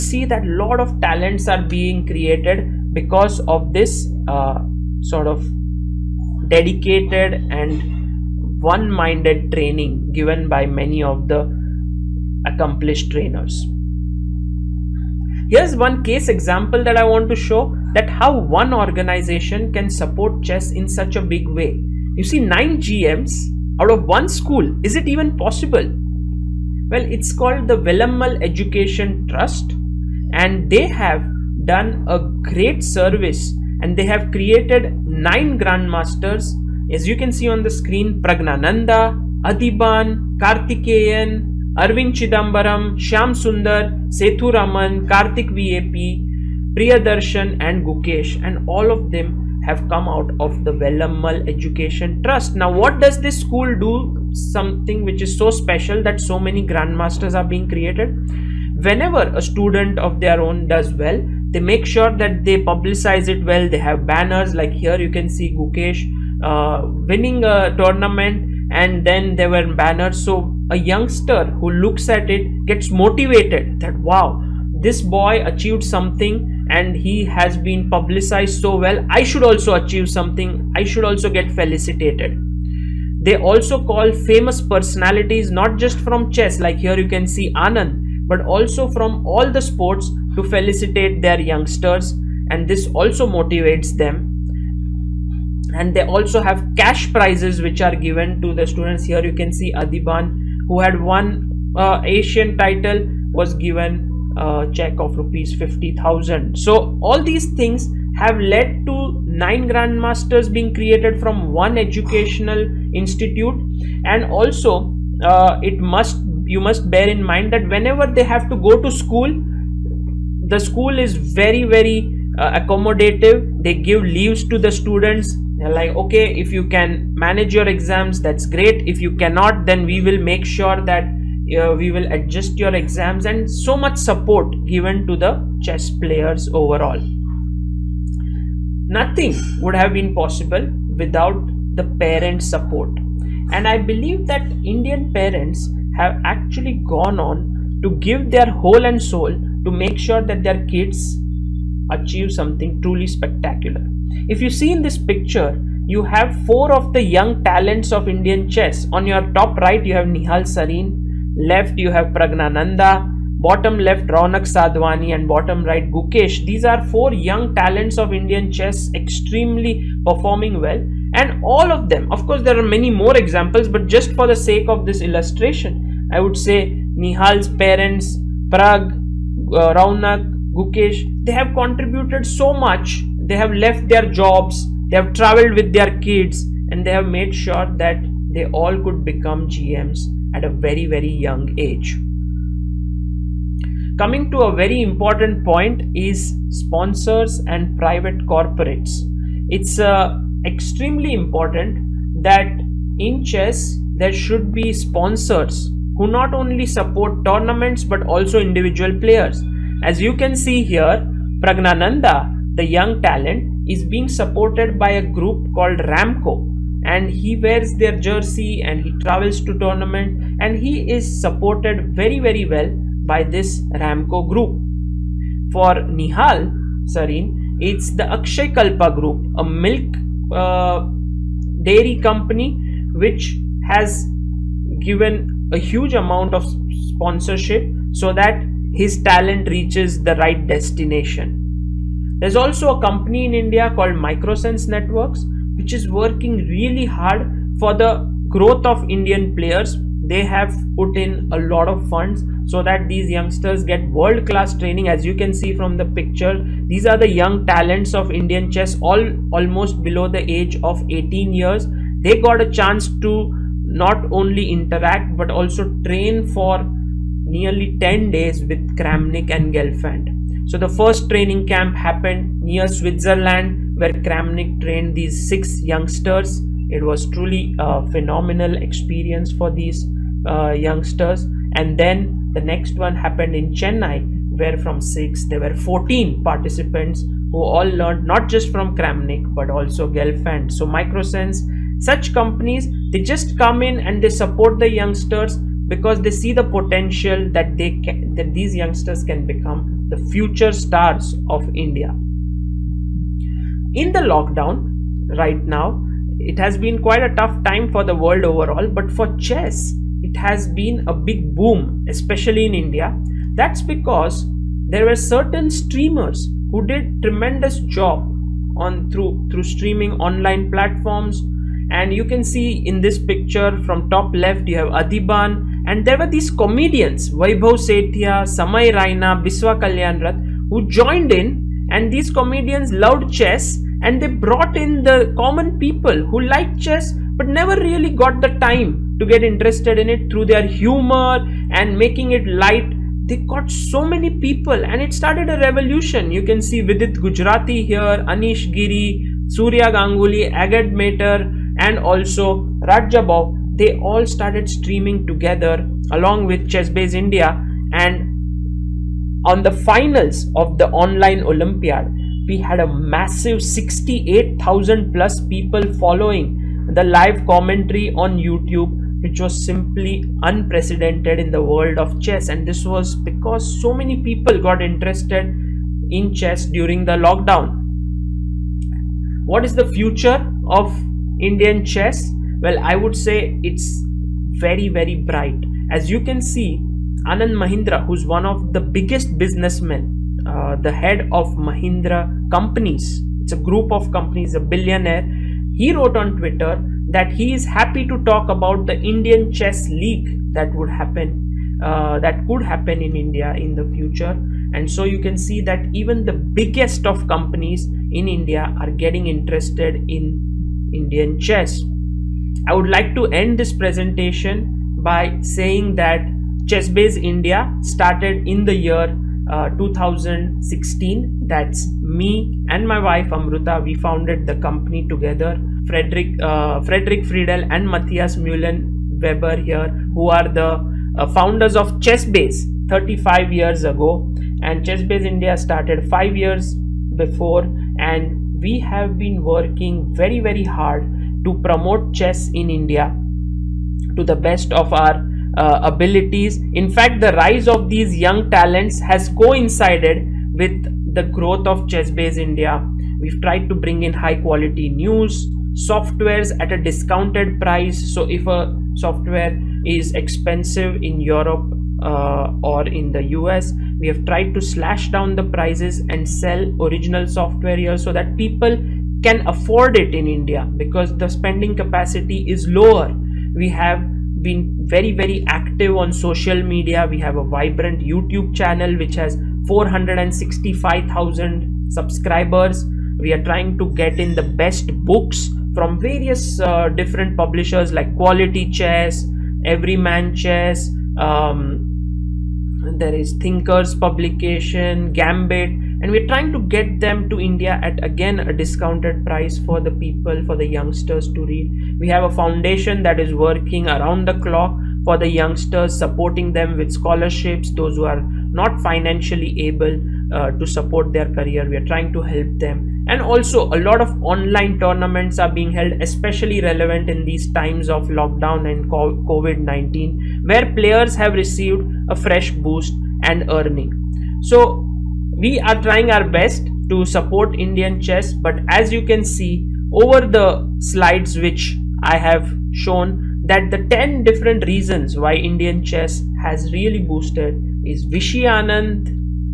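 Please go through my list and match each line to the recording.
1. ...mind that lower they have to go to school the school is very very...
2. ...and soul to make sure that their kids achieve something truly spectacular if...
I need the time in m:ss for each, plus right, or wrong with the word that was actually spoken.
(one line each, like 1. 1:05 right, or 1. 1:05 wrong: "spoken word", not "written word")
1. 1:57 wrong: "whenever", not "lower"
2. 2:28 right.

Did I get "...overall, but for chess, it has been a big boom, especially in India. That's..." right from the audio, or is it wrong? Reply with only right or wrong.
right.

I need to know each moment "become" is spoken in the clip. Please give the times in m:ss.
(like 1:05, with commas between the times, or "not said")
3:09, 4:59.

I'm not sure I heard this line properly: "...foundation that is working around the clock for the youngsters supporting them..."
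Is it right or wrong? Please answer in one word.
right.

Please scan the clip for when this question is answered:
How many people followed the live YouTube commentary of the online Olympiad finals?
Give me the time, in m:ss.
6:03.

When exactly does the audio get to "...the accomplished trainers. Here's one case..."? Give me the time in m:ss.
0:11.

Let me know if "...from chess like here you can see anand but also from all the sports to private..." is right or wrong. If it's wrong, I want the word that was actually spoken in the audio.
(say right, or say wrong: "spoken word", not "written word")
wrong: "felicitate", not "private".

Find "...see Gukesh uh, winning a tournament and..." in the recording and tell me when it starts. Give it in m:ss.
1:05.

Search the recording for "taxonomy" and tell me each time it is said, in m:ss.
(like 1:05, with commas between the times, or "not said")
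not said.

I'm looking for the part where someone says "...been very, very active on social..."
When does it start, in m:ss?
7:54.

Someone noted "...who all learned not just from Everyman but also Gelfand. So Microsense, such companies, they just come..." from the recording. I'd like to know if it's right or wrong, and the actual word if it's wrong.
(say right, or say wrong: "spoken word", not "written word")
wrong: "Kramnik", not "Everyman".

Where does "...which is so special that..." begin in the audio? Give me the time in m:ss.
0:55.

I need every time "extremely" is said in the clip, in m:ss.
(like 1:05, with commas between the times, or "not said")
2:48, 3:20.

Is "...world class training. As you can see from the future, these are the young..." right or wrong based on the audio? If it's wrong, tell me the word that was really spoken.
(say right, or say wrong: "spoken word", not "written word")
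wrong: "picture", not "future".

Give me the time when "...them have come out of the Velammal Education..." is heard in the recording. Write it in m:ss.
0:49.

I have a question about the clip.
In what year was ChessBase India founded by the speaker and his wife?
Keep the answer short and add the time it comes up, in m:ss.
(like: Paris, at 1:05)
2016, at 6:59.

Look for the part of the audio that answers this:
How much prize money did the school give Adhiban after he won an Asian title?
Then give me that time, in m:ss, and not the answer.
1:45.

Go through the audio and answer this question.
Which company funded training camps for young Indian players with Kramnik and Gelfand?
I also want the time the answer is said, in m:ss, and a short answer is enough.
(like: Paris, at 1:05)
Microsense Networks, at 4:03.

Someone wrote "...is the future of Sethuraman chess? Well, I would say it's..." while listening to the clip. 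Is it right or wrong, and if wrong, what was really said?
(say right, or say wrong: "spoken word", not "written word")
wrong: "Indian", not "Sethuraman".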